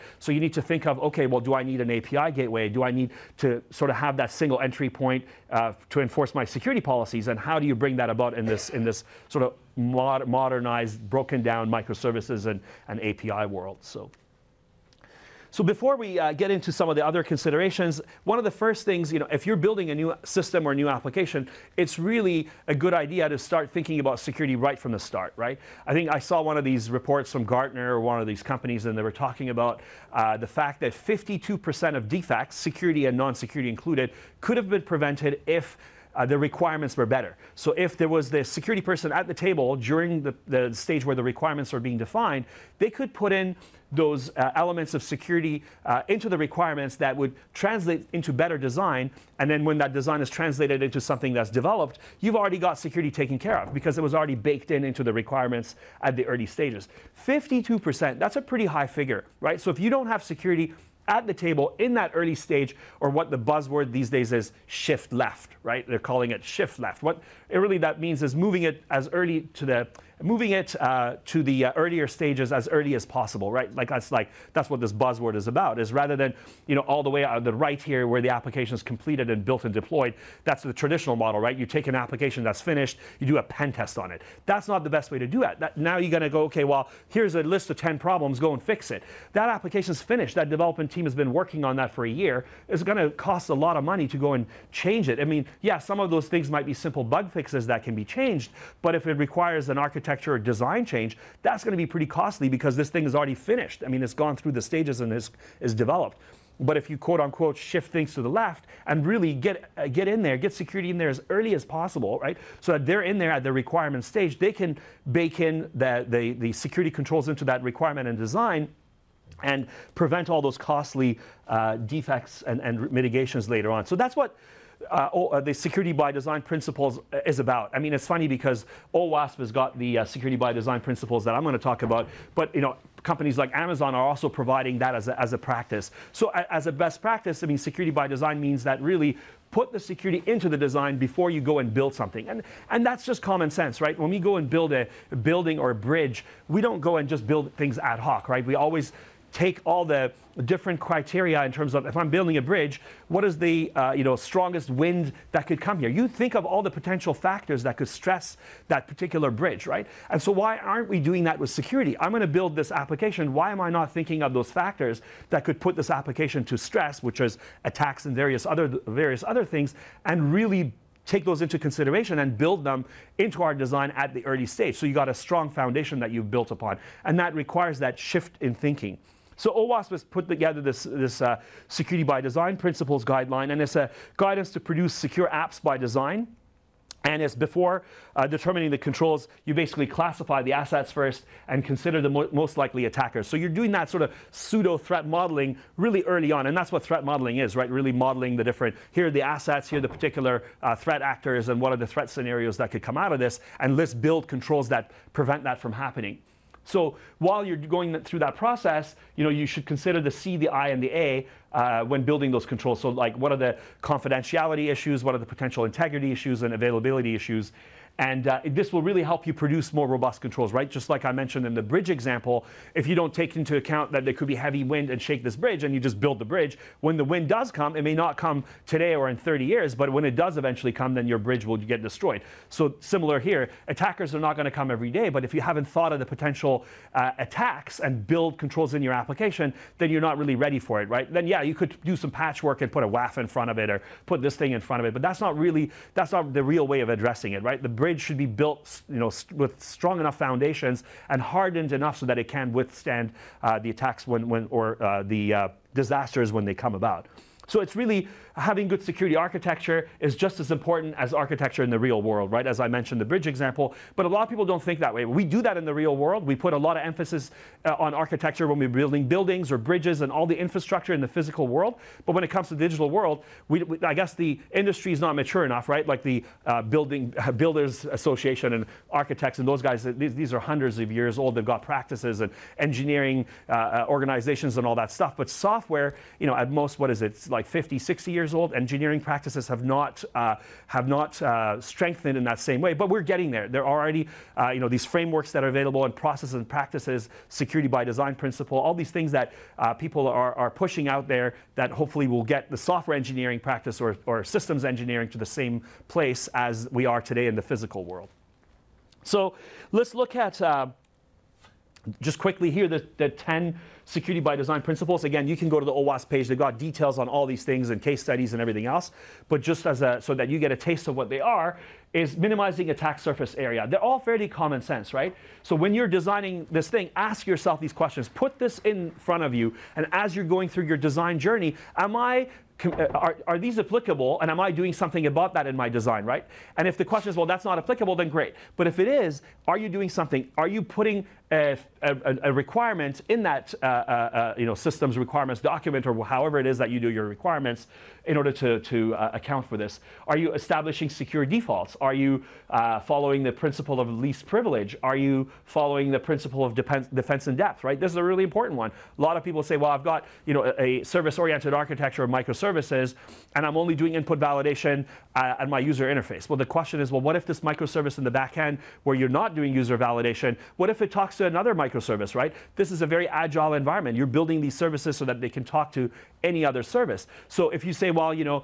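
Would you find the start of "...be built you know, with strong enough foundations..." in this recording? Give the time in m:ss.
4:08.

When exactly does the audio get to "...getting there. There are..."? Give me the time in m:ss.
4:53.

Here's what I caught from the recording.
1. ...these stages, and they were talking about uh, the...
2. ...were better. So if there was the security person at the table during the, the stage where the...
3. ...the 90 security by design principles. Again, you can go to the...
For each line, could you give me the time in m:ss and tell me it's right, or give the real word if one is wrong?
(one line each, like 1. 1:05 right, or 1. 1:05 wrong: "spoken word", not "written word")
1. 0:28 wrong: "companies", not "stages"
2. 0:36 right
3. 5:12 wrong: "10", not "90".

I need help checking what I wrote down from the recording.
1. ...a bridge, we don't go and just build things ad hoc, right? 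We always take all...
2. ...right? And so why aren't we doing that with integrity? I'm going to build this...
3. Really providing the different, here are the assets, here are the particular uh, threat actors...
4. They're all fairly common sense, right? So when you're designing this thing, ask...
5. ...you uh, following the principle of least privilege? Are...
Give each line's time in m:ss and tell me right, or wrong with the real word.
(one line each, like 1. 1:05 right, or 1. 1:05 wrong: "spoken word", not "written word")
1. 2:25 right
2. 2:39 wrong: "security", not "integrity"
3. 3:17 wrong: "modeling", not "providing"
4. 5:23 right
5. 5:51 right.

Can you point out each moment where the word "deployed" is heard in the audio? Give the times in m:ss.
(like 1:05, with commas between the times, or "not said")
1:19.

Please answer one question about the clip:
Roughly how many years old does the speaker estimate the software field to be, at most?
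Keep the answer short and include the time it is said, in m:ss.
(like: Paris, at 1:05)
50 to 60 years, at 4:47.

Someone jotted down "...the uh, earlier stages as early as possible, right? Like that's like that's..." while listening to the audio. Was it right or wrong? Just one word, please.
right.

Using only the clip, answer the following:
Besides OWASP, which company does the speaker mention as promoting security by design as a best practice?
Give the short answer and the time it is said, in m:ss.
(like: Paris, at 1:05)
Amazon, at 2:13.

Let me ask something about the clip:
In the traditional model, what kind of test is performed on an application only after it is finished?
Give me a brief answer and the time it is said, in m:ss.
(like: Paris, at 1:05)
pen test, at 1:23.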